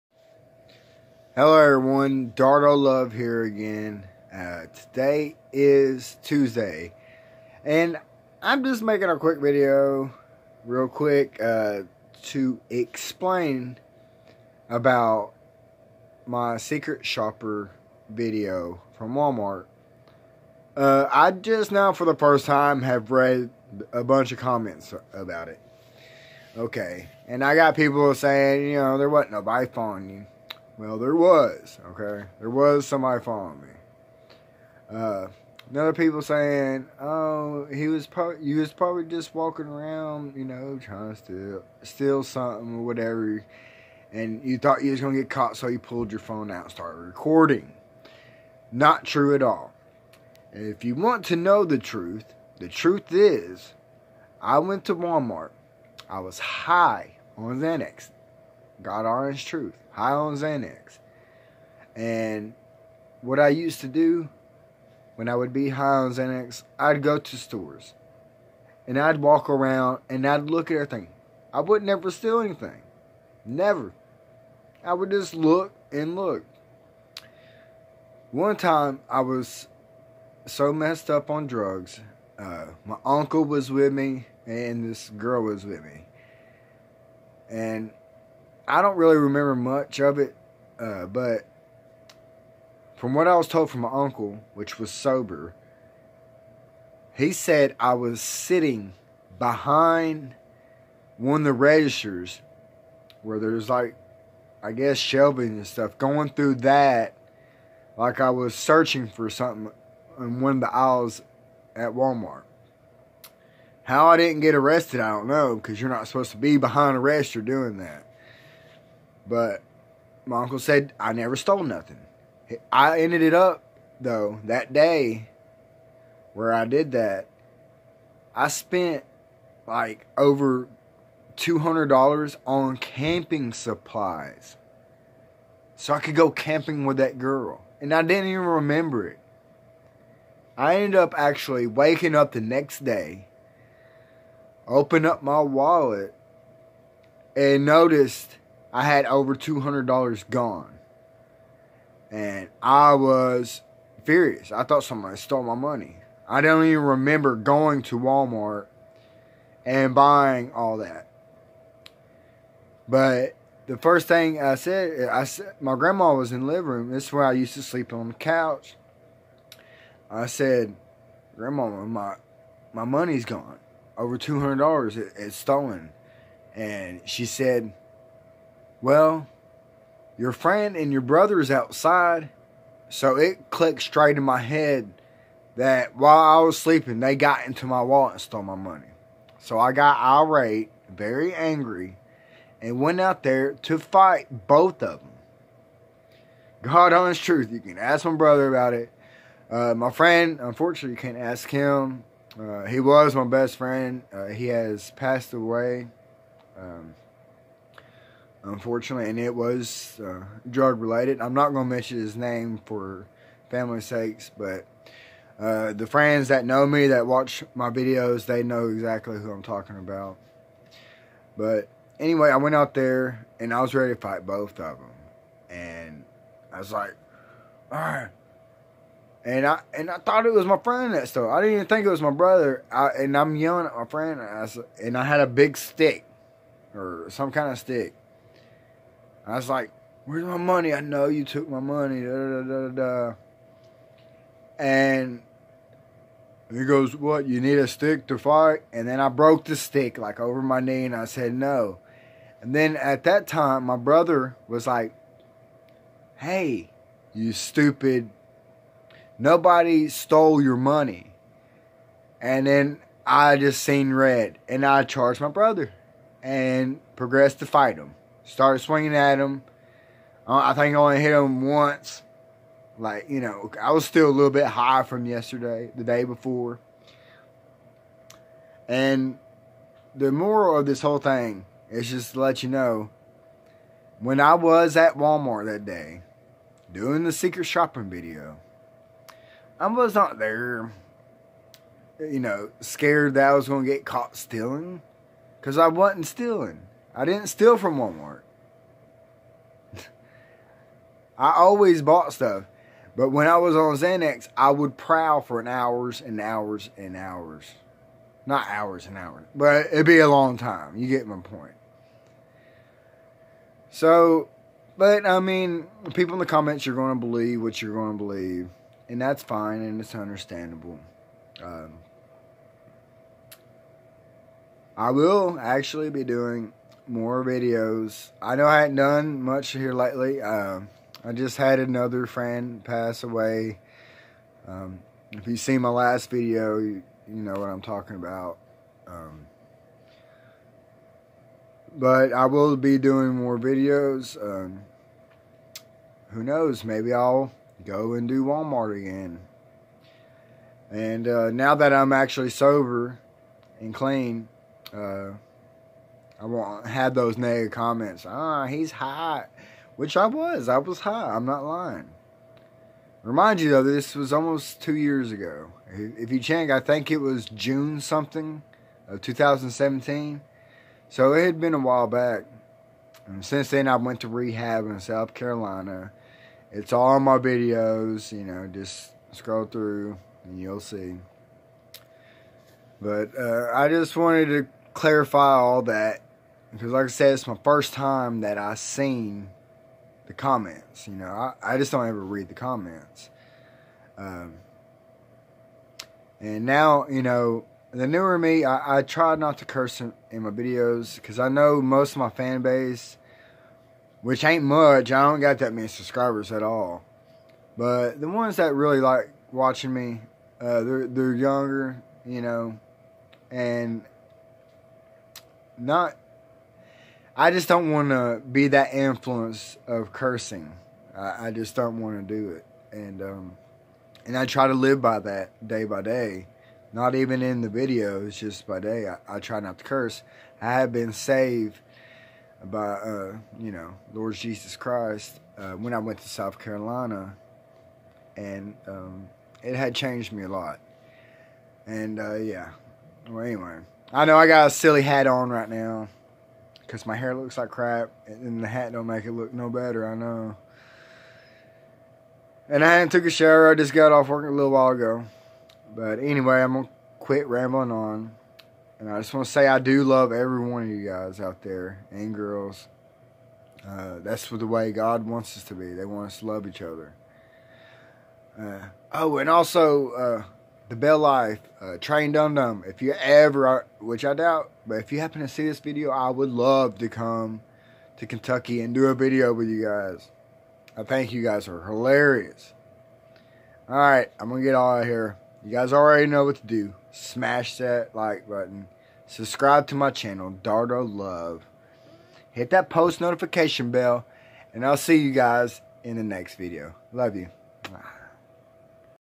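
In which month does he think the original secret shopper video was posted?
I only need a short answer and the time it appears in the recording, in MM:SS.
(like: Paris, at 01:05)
June, at 06:07.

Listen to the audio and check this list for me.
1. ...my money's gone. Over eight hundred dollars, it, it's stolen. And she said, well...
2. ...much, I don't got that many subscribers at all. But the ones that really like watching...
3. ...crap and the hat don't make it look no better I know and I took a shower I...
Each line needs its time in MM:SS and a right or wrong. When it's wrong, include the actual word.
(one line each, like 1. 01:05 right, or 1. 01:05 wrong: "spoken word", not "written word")
1. 02:52 wrong: "two", not "eight"
2. 06:44 right
3. 07:27 right.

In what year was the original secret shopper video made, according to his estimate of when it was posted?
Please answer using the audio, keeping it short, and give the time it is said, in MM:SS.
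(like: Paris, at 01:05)
2017, at 06:09.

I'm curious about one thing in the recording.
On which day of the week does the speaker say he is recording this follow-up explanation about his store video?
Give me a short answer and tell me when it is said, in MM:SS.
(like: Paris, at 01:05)
Tuesday, at 00:06.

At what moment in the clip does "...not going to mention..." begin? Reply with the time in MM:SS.
03:31.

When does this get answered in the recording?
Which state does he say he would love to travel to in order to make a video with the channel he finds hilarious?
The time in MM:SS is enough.
07:58.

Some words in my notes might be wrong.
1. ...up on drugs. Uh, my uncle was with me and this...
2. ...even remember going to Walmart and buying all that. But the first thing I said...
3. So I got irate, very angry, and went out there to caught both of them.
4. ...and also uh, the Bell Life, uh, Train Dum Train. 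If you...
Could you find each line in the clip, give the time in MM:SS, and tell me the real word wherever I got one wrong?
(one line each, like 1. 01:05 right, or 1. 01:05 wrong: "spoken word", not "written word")
1. 01:21 right
2. 02:36 right
3. 03:09 wrong: "fight", not "caught"
4. 07:49 wrong: "Dum", not "Train".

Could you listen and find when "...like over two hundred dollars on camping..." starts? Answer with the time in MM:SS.
02:09.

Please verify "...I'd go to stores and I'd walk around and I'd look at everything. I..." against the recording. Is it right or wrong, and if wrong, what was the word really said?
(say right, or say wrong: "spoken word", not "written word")
right.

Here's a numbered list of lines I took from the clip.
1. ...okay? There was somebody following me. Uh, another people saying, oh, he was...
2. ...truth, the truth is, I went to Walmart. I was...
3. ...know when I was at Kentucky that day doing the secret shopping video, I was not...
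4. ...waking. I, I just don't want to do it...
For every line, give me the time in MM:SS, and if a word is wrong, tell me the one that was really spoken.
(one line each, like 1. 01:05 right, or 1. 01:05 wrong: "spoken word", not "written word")
1. 00:31 right
2. 00:51 right
3. 04:42 wrong: "Walmart", not "Kentucky"
4. 06:59 wrong: "cursing", not "waking".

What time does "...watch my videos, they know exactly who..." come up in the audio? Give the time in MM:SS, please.
03:37.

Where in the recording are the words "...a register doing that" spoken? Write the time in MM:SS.
01:56.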